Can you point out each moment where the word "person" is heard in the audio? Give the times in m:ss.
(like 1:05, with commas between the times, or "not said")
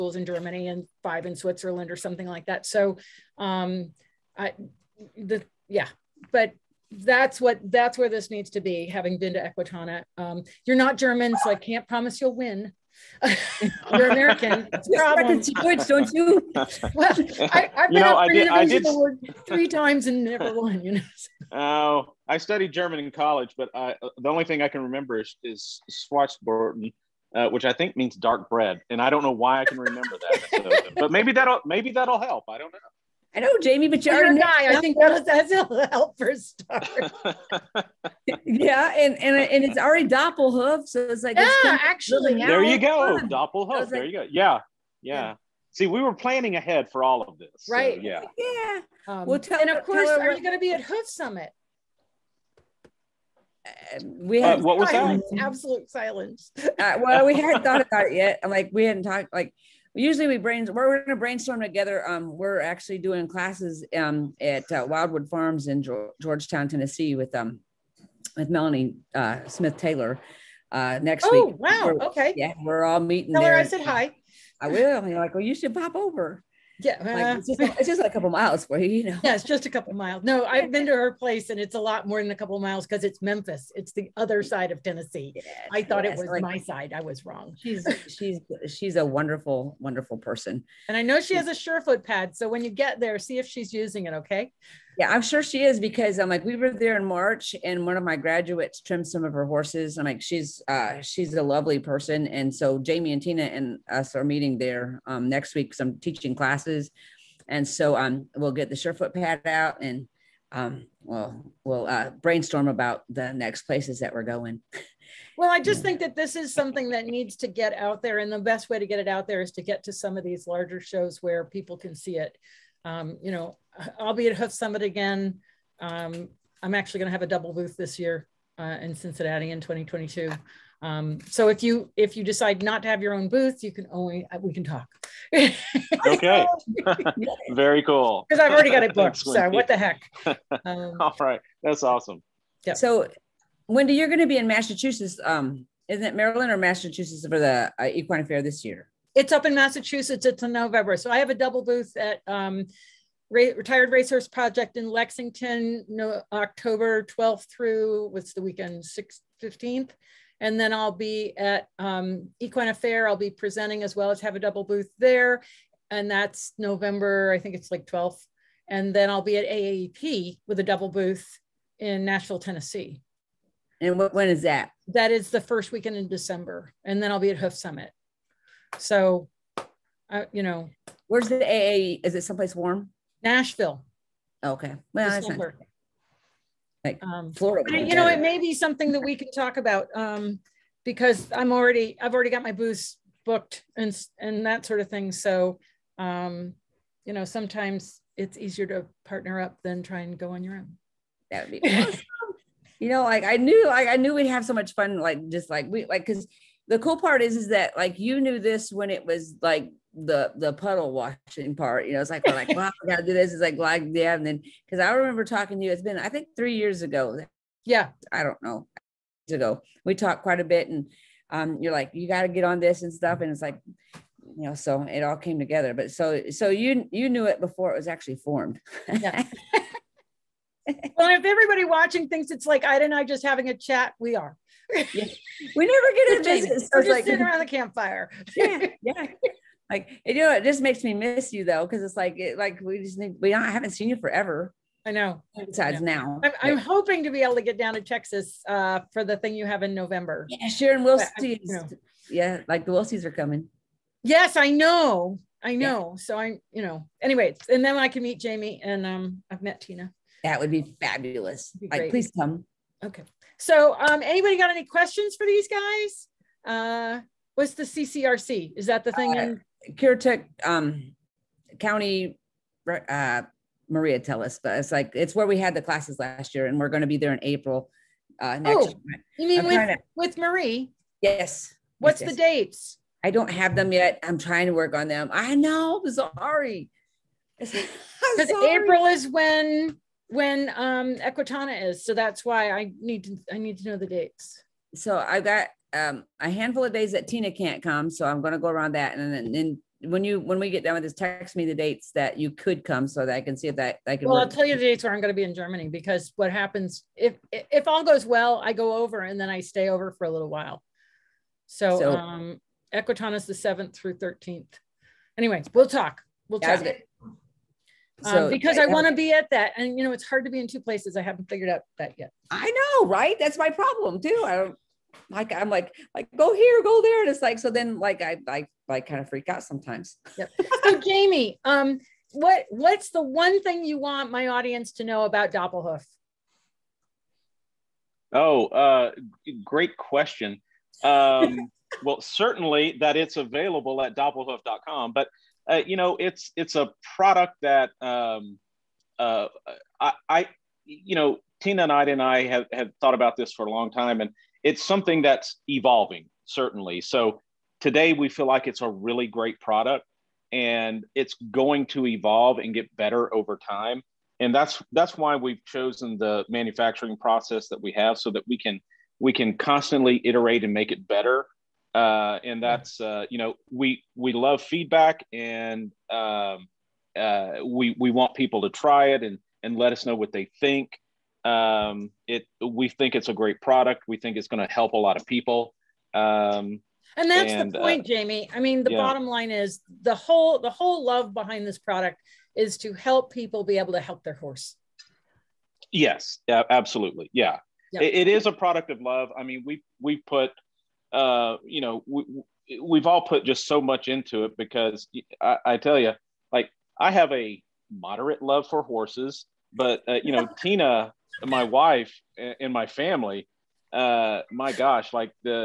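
1:30, 1:41.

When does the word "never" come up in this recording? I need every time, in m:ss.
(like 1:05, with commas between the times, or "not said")
0:20, 3:54.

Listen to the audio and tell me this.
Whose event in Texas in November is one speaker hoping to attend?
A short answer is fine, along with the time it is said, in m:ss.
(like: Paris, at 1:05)
Sharon Wilson, at 4:10.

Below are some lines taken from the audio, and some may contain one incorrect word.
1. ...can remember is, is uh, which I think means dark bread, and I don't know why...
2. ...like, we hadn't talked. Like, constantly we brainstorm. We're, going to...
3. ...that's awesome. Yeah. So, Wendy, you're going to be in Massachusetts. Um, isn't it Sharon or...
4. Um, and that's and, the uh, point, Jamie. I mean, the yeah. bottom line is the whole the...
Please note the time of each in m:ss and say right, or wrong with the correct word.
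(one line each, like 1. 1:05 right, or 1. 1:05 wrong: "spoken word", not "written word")
1. 0:24 right
2. 0:58 wrong: "usually", not "constantly"
3. 2:21 wrong: "Maryland", not "Sharon"
4. 6:25 right.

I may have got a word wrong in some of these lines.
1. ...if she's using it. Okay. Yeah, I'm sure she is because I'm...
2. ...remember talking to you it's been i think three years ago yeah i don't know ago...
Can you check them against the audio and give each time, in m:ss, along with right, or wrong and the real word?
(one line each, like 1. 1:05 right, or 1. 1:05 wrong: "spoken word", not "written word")
1. 1:33 right
2. 3:34 right.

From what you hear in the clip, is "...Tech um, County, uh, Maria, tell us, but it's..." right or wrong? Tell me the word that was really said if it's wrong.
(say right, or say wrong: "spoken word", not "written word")
right.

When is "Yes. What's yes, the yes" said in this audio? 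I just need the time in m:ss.
4:40.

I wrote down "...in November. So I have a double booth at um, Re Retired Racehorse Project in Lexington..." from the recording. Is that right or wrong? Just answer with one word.
right.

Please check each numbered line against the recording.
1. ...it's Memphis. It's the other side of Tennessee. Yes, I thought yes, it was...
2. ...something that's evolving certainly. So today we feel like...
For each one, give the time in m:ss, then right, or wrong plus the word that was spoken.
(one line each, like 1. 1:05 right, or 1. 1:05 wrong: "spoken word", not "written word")
1. 1:23 right
2. 5:54 right.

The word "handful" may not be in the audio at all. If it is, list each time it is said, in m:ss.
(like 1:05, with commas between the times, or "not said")
4:56.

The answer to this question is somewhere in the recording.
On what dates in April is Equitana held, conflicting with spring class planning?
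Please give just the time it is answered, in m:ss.
5:13.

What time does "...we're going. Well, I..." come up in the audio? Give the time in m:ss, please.
1:54.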